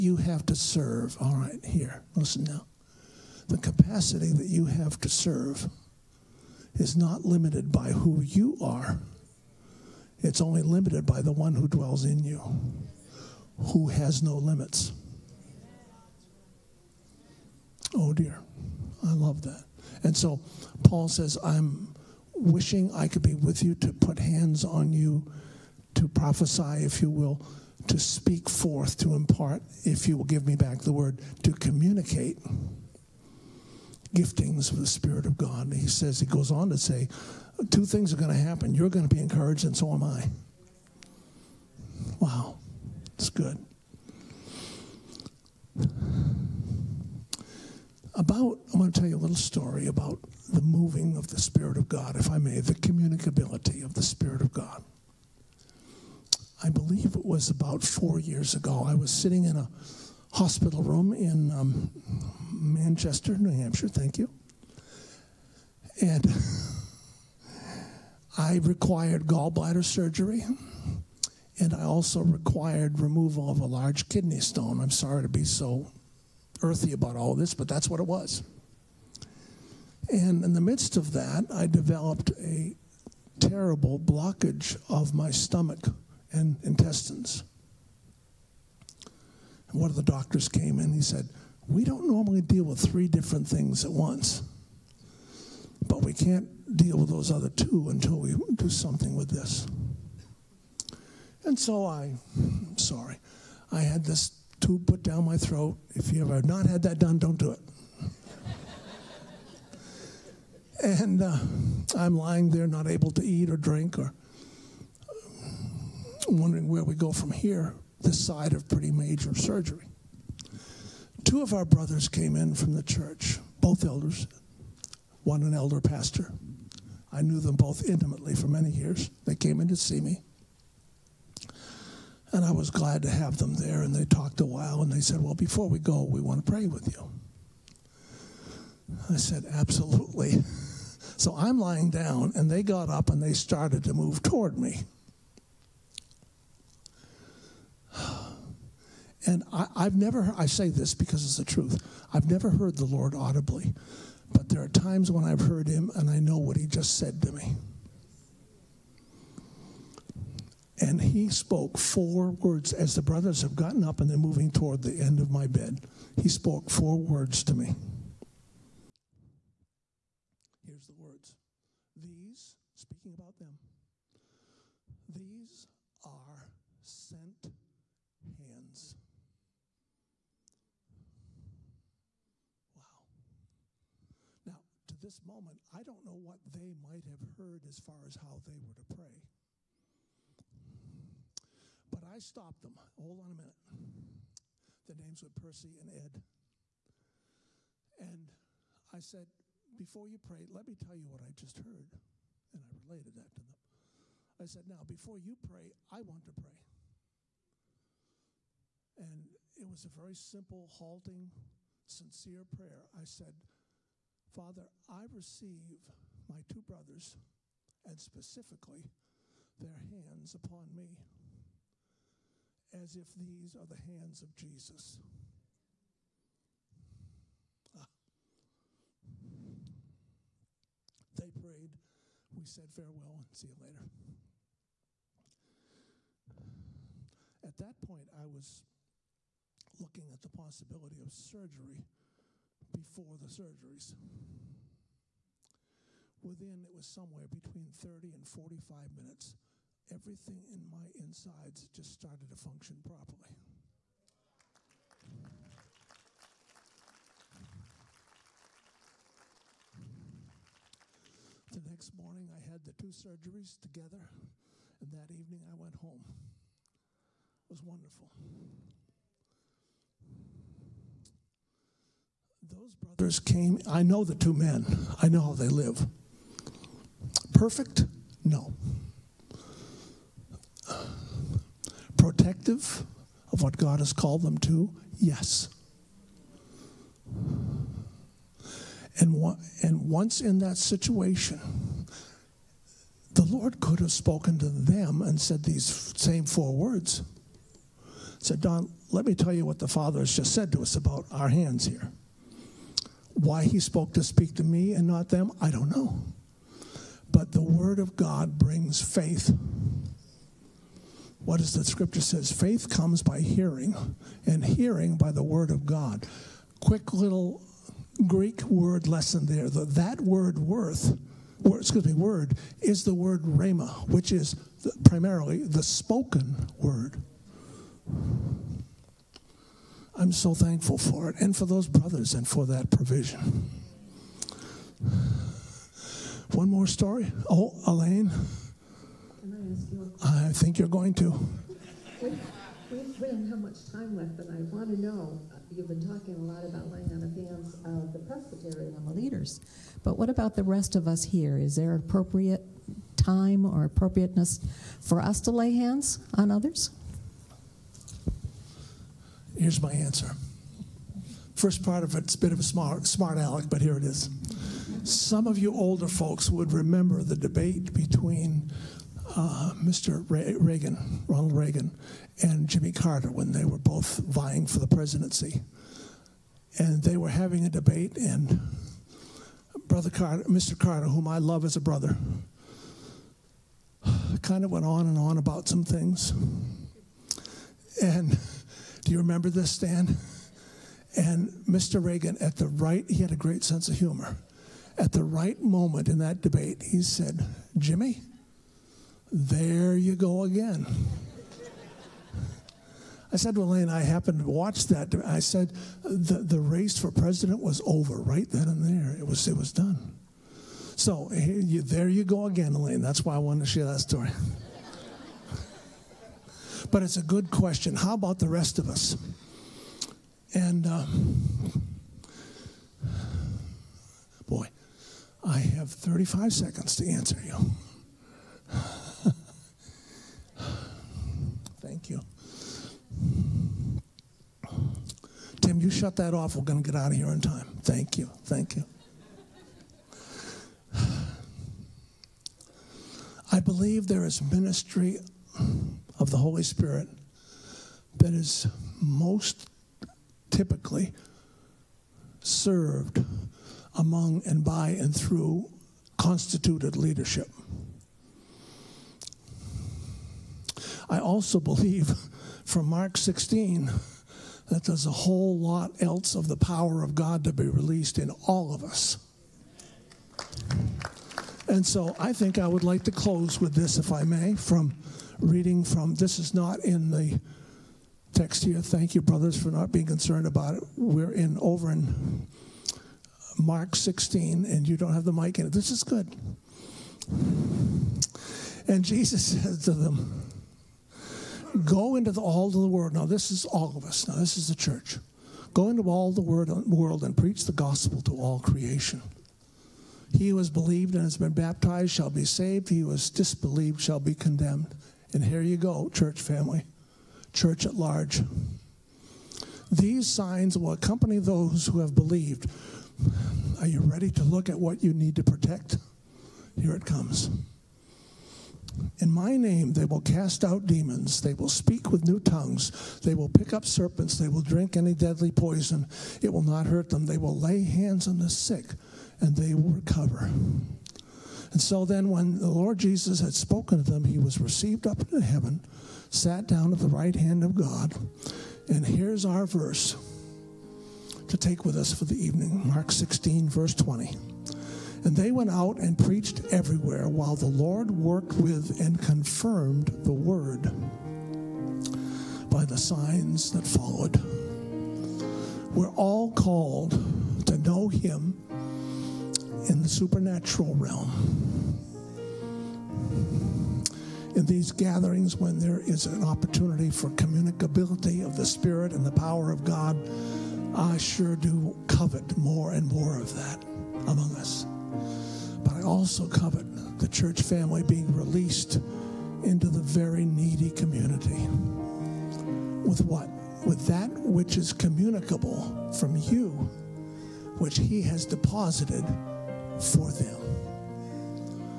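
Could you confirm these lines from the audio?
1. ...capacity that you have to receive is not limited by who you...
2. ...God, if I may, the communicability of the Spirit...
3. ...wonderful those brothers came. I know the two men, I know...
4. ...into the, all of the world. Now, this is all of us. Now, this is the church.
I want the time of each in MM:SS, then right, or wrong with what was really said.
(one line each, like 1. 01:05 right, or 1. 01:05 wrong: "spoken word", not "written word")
1. 00:03 wrong: "serve", not "receive"
2. 00:51 right
3. 04:27 right
4. 08:11 right.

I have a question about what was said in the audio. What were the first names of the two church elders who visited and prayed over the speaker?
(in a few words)
Percy and Ed.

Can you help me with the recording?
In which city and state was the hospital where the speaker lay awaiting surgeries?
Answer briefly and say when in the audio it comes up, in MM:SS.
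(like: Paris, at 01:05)
Manchester, New Hampshire, at 01:02.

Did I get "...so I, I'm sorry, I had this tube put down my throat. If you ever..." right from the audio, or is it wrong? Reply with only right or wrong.
right.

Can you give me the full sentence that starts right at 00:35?
He says, he goes on to say, two things are going to happen.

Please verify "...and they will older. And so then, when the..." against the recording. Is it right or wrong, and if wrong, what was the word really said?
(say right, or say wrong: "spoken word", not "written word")
wrong: "recover", not "older".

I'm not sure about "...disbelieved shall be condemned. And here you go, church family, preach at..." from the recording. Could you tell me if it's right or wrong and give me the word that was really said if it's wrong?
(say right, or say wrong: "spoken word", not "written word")
wrong: "church", not "preach".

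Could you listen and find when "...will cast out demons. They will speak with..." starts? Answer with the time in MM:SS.
08:39.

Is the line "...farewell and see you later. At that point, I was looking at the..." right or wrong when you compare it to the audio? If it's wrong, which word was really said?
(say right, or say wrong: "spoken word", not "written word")
right.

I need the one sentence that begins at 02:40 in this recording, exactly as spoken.
And he spoke four words as the brothers have gotten up and they're moving toward the end of my bed.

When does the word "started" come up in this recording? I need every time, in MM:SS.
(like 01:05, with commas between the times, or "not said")
02:23, 04:11.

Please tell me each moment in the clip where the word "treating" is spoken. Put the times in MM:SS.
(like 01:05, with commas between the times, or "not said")
not said.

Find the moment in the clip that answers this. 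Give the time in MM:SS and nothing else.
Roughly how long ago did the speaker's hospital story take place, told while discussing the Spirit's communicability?
00:57.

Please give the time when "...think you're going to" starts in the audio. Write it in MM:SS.
05:40.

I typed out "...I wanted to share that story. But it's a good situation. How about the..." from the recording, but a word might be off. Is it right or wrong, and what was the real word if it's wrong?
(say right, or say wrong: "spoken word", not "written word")
wrong: "question", not "situation".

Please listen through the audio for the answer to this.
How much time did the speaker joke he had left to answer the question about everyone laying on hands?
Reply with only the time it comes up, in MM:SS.
07:05.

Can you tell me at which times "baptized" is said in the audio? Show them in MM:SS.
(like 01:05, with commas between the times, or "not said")
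08:21.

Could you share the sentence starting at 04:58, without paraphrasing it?
Said, Don, let me tell you what the Father has just said to us about our hands here.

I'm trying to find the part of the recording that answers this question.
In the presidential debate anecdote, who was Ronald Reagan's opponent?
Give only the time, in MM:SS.
06:12.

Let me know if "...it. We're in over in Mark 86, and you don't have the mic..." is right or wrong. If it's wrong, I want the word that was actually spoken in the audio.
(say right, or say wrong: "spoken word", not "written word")
wrong: "16", not "86".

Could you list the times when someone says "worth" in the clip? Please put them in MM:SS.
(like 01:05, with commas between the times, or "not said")
05:20.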